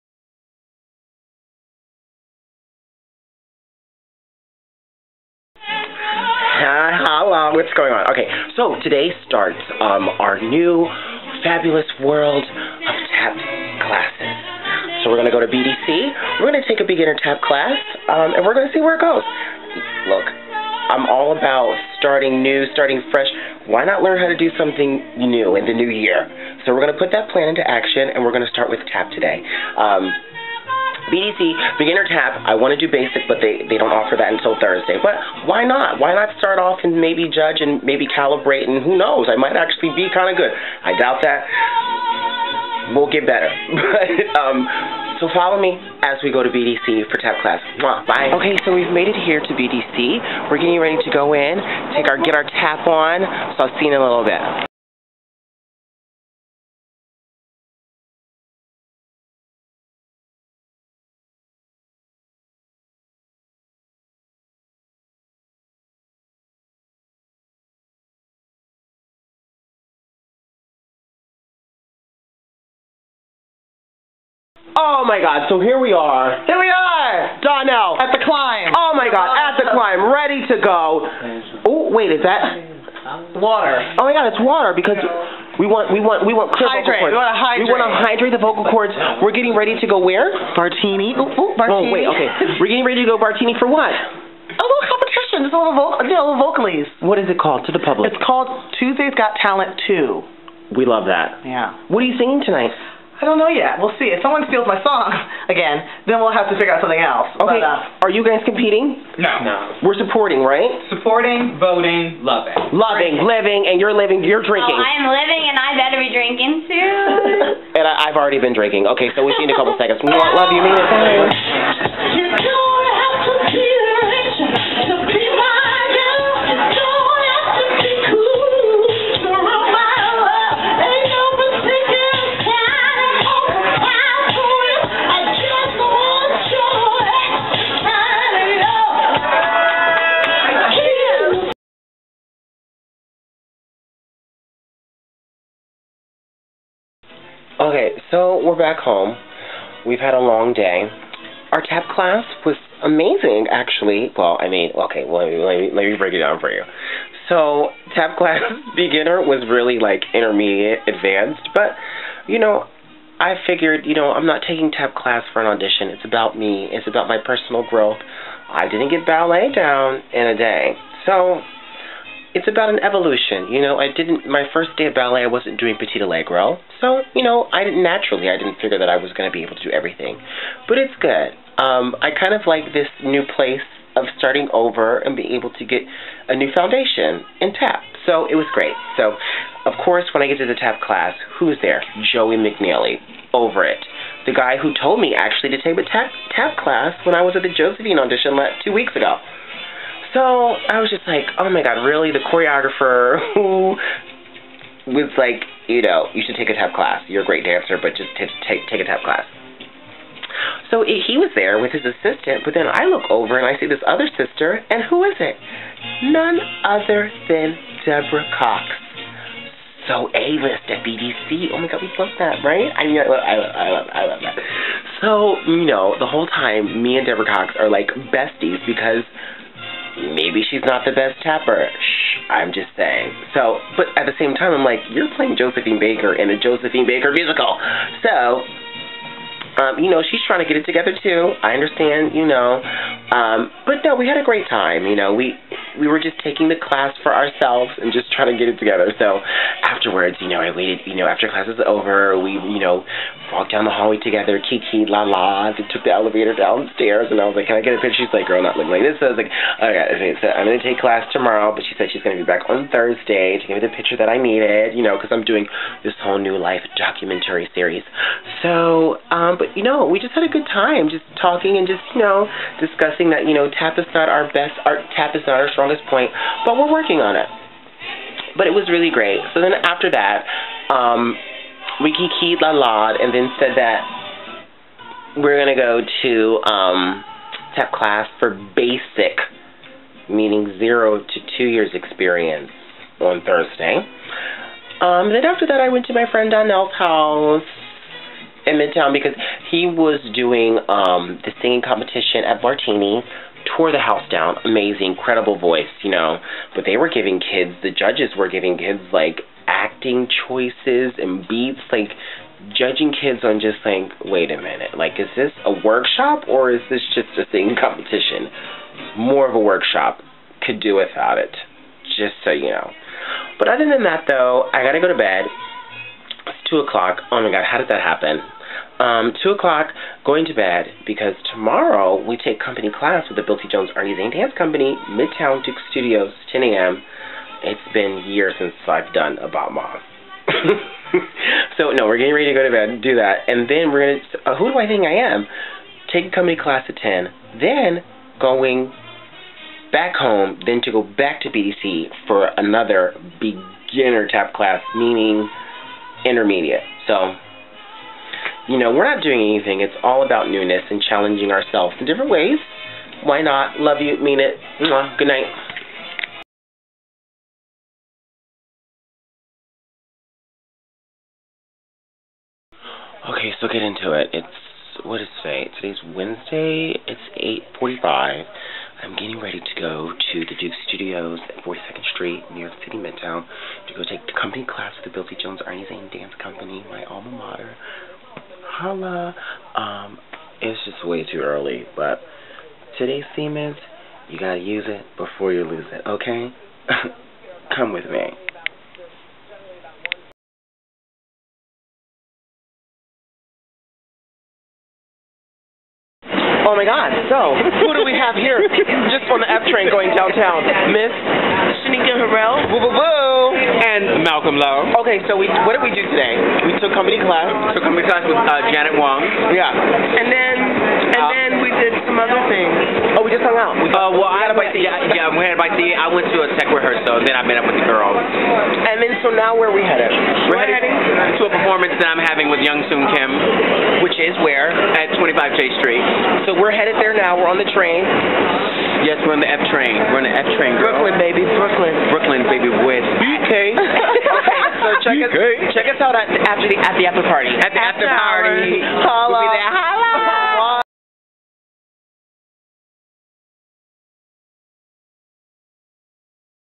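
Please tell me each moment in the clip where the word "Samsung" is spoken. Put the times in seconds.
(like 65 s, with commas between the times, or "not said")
not said.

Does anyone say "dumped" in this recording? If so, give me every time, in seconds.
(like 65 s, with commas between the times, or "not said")
not said.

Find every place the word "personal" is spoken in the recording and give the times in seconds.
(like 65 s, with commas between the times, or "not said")
167 s.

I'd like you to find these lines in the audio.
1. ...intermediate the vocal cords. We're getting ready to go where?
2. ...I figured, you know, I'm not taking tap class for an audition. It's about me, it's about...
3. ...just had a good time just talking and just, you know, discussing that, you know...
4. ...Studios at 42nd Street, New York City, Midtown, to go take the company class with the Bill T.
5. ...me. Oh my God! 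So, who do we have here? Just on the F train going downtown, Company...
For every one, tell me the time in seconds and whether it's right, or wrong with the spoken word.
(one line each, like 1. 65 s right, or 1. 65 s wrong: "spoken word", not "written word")
1. 87 s wrong: "hydrate", not "intermediate"
2. 163 s right
3. 270 s right
4. 380 s right
5. 397 s wrong: "Miss", not "Company".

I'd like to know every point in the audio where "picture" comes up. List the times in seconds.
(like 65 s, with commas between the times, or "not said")
257 s, 263 s.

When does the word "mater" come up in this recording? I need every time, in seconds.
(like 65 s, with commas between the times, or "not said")
387 s.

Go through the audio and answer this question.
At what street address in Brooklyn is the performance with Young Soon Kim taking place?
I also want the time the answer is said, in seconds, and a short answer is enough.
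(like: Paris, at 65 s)
25 Jay Street, at 434 s.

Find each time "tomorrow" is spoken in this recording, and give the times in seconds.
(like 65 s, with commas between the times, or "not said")
261 s, 331 s.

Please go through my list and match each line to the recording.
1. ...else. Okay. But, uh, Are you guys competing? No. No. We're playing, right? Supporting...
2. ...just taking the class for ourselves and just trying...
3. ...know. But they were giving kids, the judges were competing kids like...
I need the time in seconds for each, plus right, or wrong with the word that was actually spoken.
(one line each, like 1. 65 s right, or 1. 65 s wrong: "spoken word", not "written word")
1. 106 s wrong: "supporting", not "playing"
2. 245 s right
3. 305 s wrong: "giving", not "competing".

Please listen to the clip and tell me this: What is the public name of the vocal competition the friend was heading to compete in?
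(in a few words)
Tuesday's Got Talent 2.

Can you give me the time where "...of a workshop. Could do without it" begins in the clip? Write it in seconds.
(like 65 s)
319 s.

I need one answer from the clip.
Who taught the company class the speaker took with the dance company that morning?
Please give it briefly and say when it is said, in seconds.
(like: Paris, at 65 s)
Janet Wong, at 418 s.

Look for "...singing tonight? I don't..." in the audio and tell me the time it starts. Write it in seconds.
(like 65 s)
102 s.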